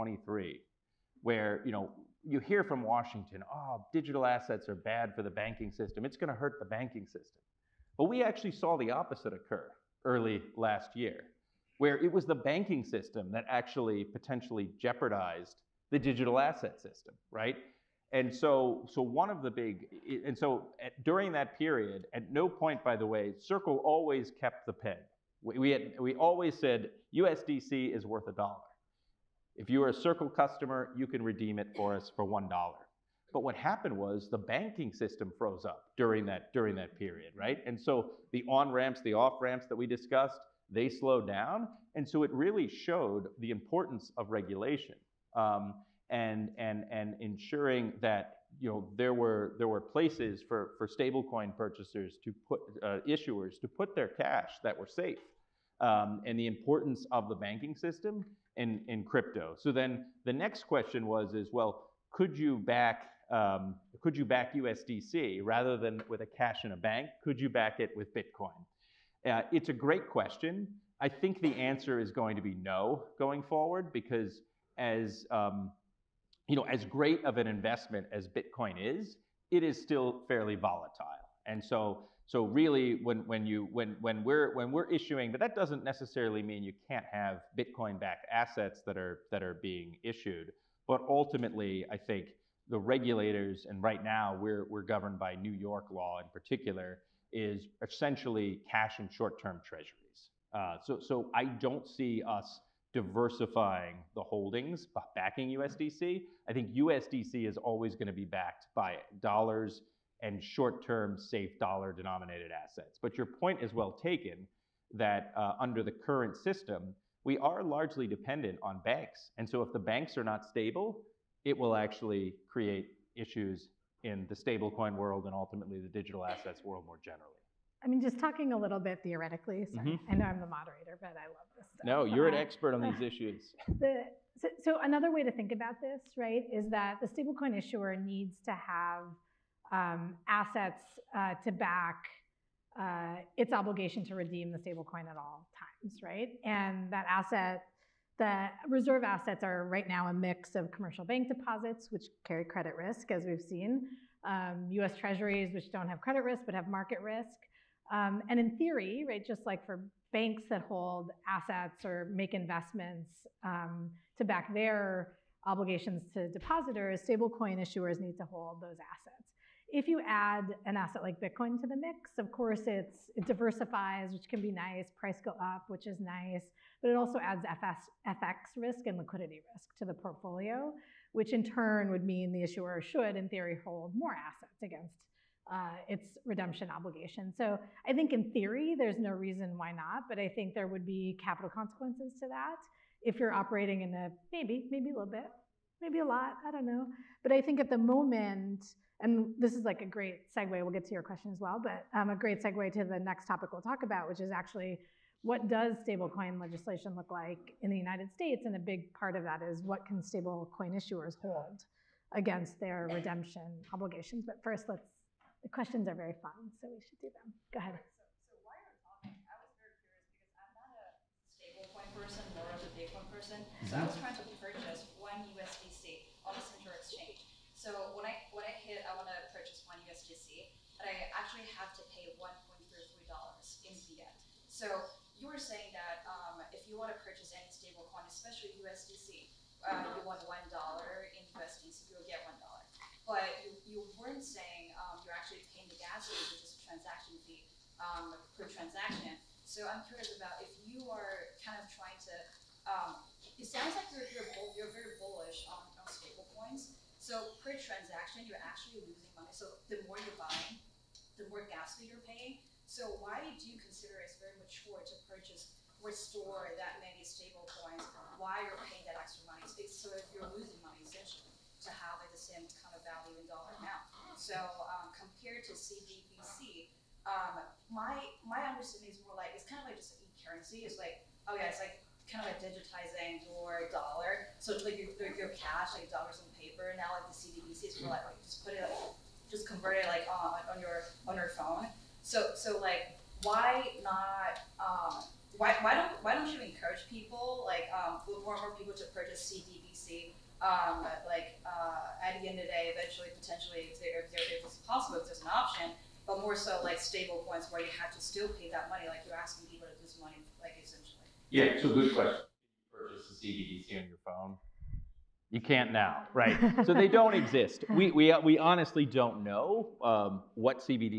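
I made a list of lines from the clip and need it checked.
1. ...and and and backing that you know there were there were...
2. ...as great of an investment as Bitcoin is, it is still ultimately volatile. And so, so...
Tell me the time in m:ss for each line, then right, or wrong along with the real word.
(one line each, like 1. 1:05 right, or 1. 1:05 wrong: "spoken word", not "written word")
1. 0:46 wrong: "ensuring", not "backing"
2. 1:16 wrong: "fairly", not "ultimately".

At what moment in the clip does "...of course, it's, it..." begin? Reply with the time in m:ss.
2:52.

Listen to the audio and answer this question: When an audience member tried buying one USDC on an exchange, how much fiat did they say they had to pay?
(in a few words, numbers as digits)
$1.33.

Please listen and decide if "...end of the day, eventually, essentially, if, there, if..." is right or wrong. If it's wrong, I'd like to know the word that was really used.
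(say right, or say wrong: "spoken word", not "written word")
wrong: "potentially", not "essentially".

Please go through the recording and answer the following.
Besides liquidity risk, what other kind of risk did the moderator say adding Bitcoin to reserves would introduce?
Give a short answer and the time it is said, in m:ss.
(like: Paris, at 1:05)
FX risk, at 2:58.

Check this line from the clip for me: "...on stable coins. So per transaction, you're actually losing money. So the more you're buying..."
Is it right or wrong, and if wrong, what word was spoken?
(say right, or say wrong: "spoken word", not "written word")
right.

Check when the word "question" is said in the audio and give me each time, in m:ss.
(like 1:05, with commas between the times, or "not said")
1:00, 1:10, 3:21, 3:35, 5:11.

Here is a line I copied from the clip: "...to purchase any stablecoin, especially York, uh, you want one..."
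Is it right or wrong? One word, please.
wrong.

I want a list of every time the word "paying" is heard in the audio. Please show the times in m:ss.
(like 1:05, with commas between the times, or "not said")
4:05, 4:22, 4:28.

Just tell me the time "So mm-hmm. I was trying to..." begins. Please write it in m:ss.
3:43.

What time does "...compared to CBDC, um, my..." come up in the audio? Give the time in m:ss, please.
4:34.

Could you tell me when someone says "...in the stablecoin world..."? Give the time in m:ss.
2:04.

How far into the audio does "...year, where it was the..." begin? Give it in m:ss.
0:10.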